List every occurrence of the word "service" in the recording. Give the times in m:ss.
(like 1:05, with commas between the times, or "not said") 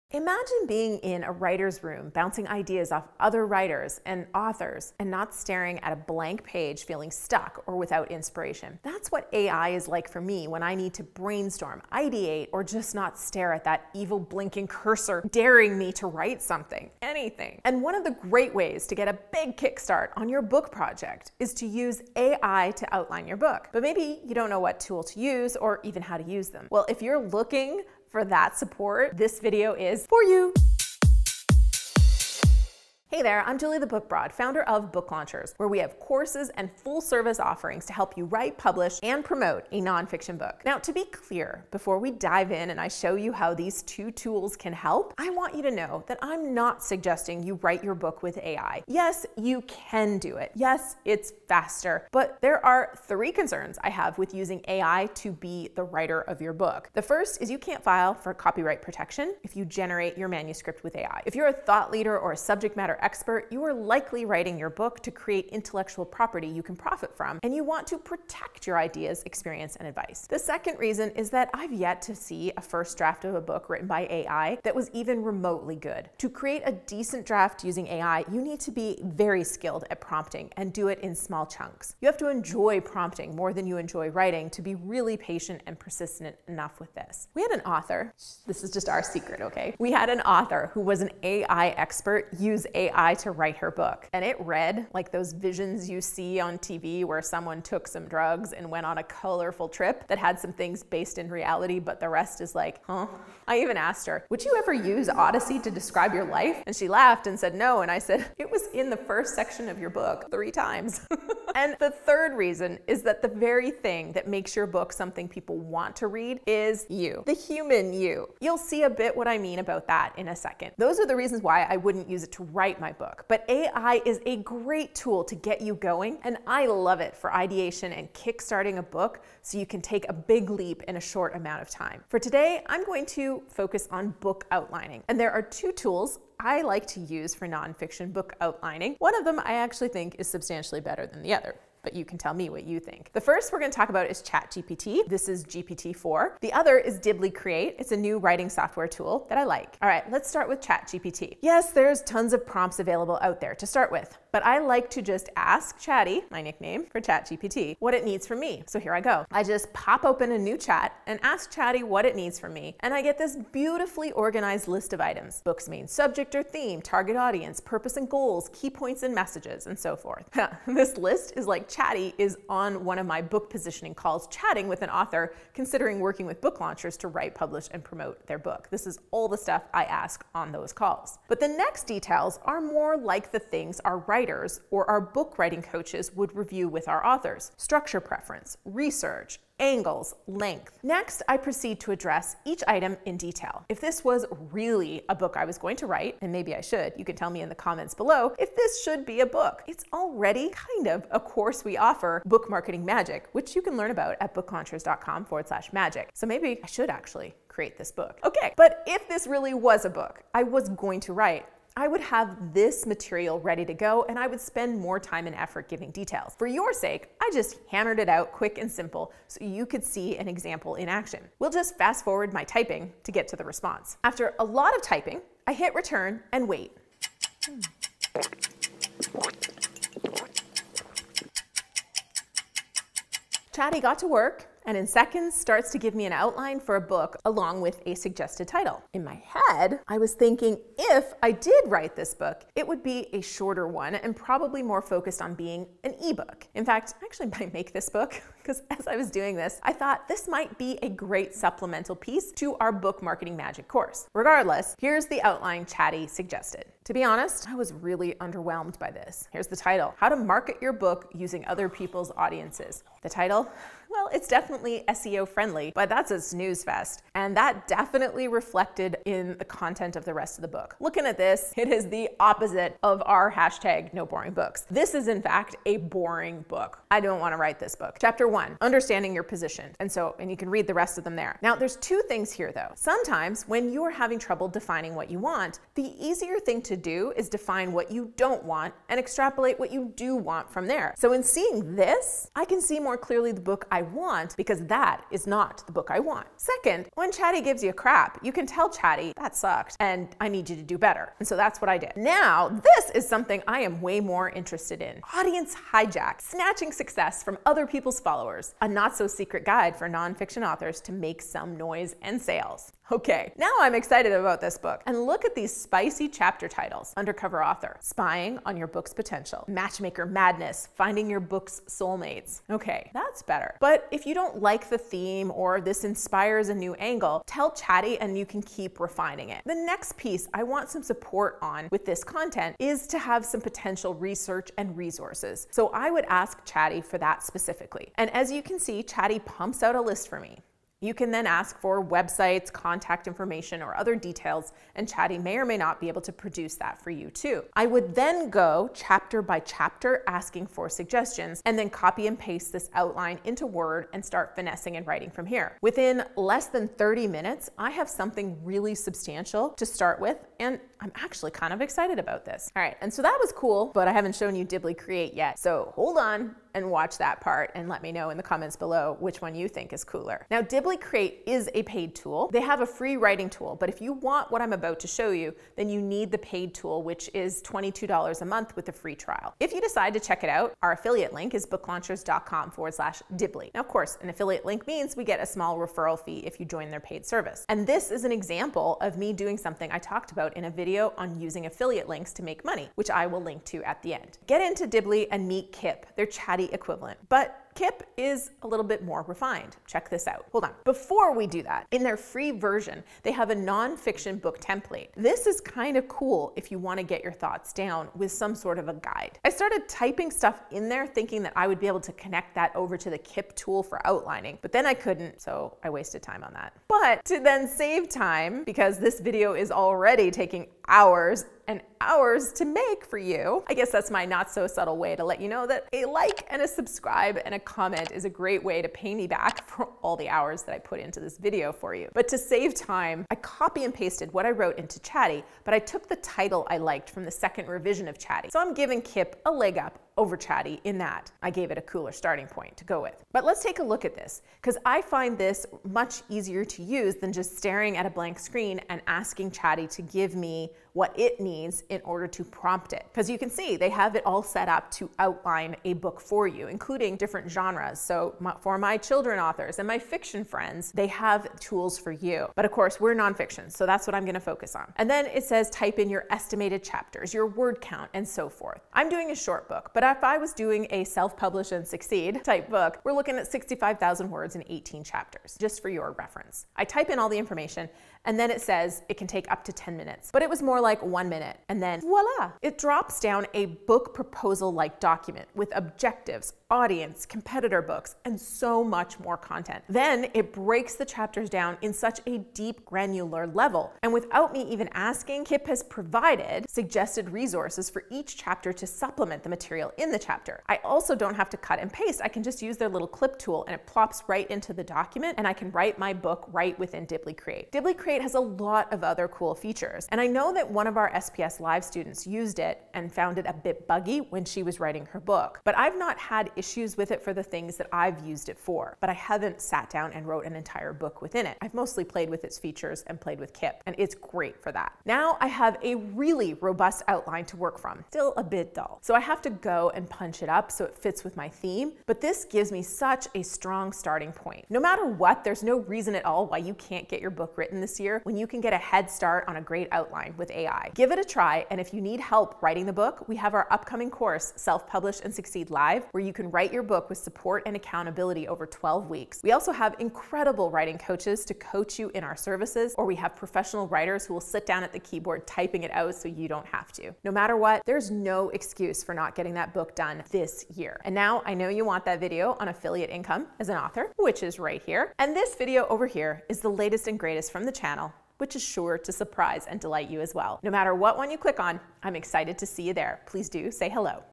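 0:37, 6:27, 9:12.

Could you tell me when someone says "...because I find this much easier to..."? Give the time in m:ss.
7:24.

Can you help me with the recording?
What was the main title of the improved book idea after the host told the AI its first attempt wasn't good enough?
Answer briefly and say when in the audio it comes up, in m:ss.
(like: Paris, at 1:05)
Audience Hijack, at 5:05.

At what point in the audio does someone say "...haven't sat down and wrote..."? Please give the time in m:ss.
8:38.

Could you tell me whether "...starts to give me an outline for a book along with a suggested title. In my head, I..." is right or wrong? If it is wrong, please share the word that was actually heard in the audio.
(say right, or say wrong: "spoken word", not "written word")
right.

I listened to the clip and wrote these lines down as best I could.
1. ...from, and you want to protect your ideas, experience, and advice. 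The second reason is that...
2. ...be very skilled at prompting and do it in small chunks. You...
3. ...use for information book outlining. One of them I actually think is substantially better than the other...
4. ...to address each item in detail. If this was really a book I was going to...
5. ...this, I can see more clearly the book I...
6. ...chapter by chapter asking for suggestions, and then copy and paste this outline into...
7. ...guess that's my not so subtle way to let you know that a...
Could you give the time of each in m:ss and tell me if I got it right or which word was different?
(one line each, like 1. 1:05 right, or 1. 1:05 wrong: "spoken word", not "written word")
1. 1:07 right
2. 1:18 right
3. 2:16 wrong: "nonfiction", not "information"
4. 3:11 right
5. 4:51 right
6. 5:48 right
7. 7:03 right.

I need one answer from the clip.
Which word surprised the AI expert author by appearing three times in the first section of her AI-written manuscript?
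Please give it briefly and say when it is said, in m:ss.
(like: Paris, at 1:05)
Odyssey, at 1:45.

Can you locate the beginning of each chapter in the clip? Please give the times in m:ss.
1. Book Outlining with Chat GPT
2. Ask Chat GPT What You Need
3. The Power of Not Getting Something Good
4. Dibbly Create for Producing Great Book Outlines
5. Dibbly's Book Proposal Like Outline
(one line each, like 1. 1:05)
1. 2:18
2. 3:43
3. 4:59
4. 6:14
5. 8:05.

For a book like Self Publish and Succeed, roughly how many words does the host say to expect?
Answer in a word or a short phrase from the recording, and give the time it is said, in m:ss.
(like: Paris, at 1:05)
65,000, at 7:53.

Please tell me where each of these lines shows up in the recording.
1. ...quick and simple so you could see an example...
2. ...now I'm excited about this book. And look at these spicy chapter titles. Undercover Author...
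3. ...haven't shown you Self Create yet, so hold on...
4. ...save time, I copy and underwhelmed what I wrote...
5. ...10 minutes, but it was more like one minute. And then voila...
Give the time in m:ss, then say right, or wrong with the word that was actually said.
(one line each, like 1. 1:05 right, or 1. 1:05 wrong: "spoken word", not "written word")
1. 3:38 right
2. 5:13 right
3. 6:03 wrong: "Dibbly", not "Self"
4. 7:12 wrong: "pasted", not "underwhelmed"
5. 7:59 right.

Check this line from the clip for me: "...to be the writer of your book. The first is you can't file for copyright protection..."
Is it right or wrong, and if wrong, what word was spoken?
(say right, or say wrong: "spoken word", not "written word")
right.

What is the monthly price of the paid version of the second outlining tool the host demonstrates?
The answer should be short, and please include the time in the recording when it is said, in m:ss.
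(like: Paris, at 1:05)
$22, at 6:17.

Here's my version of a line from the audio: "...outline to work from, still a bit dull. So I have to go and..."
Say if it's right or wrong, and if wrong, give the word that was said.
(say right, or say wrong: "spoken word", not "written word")
right.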